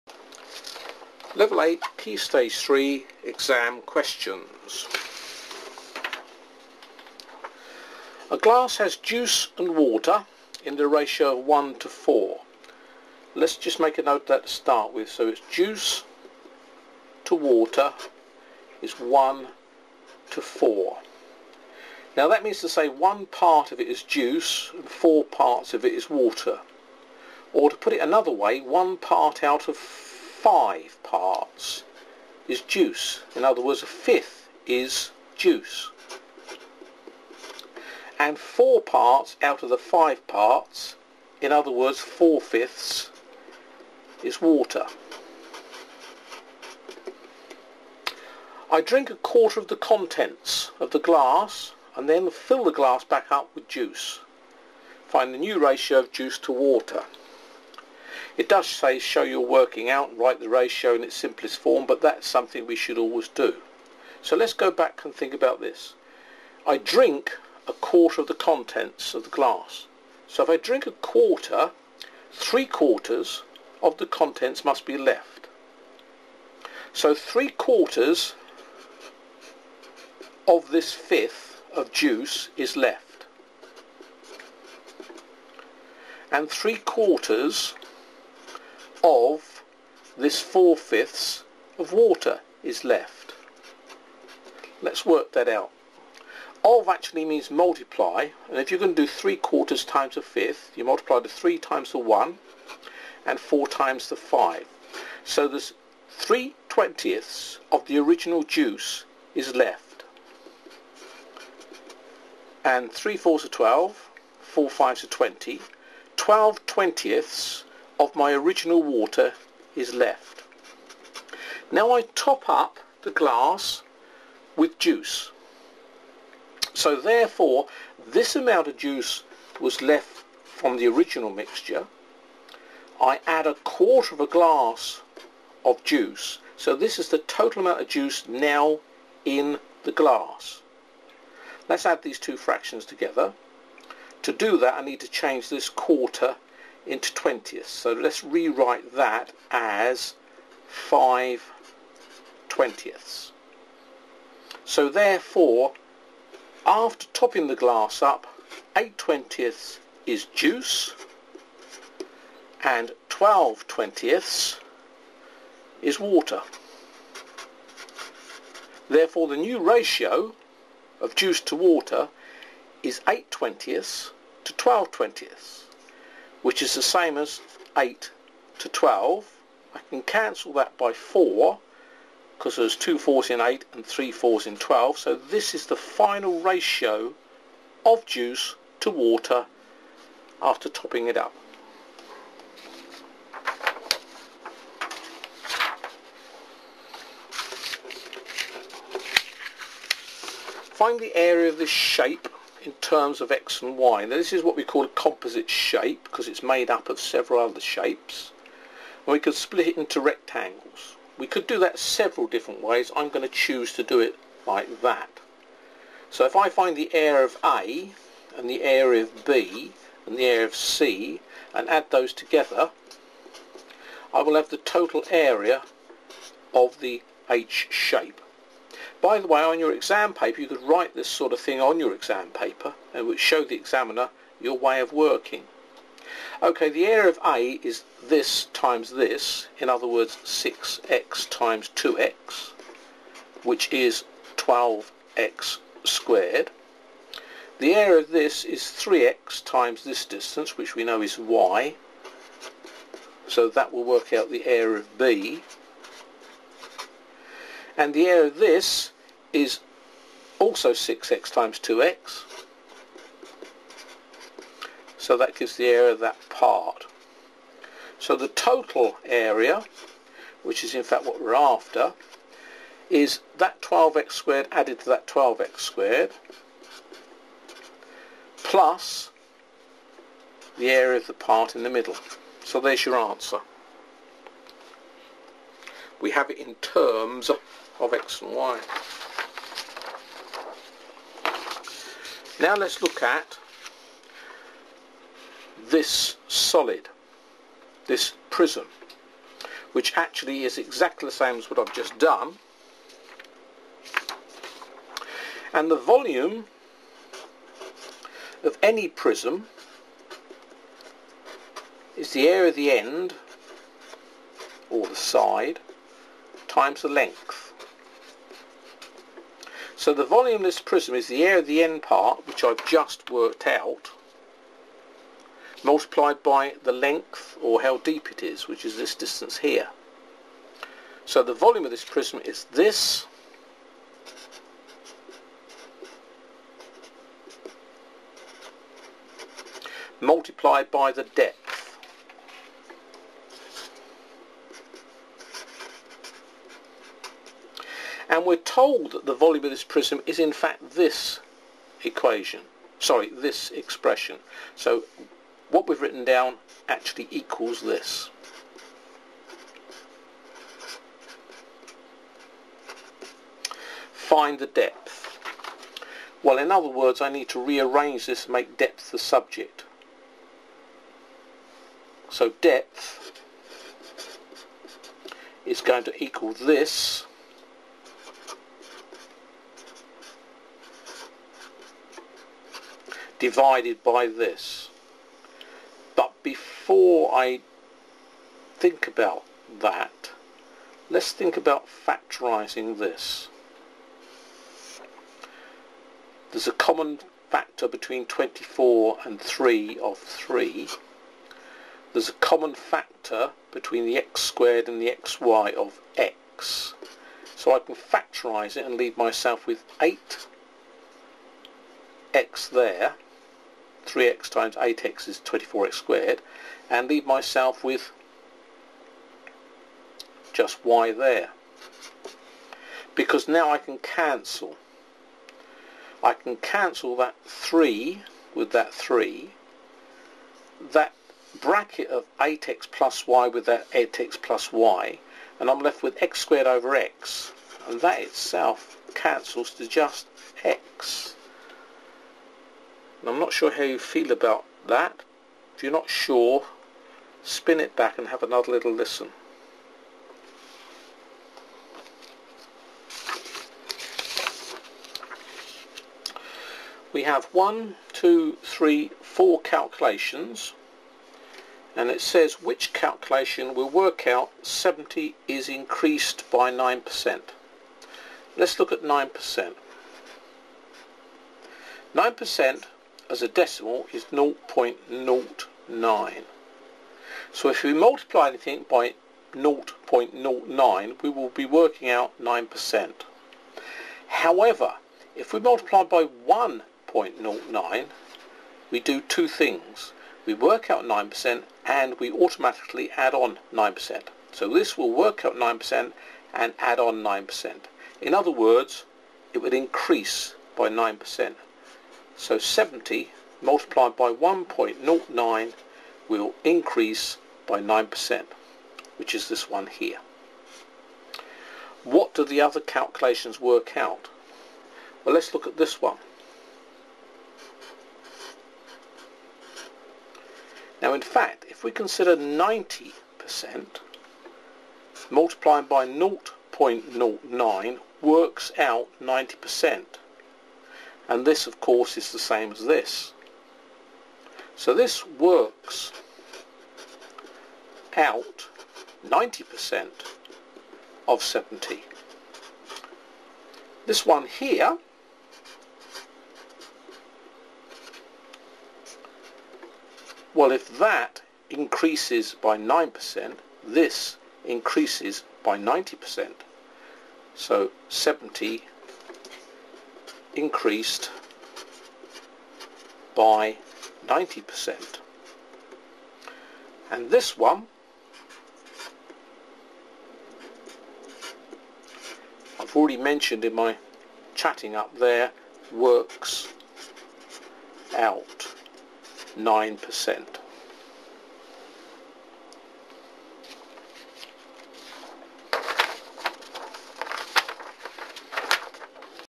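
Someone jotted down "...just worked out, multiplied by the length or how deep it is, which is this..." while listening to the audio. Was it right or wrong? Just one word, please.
right.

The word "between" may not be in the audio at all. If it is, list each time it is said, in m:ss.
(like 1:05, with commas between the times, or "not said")
6:37, 6:43.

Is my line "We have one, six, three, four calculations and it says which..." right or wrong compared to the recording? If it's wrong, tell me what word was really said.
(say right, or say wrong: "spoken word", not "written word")
wrong: "two", not "six".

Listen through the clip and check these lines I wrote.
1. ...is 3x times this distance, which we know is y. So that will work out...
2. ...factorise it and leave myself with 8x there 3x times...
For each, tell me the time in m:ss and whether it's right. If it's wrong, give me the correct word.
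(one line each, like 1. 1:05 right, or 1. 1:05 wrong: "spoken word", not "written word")
1. 4:08 right
2. 6:47 right.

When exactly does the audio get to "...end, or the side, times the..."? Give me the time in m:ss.
5:12.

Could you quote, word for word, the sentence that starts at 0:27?
Or to put it another way, one part out of five parts is juice.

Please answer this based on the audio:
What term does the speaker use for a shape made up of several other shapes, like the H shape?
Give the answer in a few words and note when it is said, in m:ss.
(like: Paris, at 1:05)
composite shape, at 3:24.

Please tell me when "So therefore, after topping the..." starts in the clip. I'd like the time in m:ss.
2:34.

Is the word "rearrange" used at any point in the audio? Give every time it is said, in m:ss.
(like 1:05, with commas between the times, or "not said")
6:07.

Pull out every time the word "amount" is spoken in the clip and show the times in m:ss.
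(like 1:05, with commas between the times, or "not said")
2:08, 2:17.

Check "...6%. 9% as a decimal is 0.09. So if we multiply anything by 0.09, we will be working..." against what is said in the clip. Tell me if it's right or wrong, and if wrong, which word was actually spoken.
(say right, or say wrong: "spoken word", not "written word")
wrong: "9", not "6".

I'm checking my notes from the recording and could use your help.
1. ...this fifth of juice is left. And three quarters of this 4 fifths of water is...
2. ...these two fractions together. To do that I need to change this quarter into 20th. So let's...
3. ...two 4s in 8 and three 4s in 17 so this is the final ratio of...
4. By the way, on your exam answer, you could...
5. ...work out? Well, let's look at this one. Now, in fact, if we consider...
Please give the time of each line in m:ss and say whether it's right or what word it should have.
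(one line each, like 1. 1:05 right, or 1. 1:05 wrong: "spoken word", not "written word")
1. 1:20 right
2. 2:22 right
3. 3:02 wrong: "12", not "17"
4. 3:49 wrong: "paper", not "answer"
5. 8:33 right.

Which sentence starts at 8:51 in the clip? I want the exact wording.
And this, of course, is the same as this.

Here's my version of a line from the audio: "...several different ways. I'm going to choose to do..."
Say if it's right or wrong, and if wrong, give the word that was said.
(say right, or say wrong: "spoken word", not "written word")
right.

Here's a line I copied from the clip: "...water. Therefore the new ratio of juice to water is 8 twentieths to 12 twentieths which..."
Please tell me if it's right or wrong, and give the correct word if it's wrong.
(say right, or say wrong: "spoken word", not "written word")
right.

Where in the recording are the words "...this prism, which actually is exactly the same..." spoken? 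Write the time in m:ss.
4:57.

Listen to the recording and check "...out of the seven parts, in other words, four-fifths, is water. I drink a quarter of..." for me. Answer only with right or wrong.
wrong.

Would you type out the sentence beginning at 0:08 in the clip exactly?
A glass has juice and water in the ratio of 1 to 4.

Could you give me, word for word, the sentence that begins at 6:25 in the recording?
But before I think about that, let's think about factorizing this.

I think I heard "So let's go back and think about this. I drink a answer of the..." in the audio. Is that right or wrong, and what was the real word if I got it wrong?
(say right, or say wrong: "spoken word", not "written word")
wrong: "quarter", not "answer".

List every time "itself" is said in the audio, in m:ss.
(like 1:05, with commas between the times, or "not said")
7:18.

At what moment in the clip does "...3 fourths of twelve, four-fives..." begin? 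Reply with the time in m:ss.
1:52.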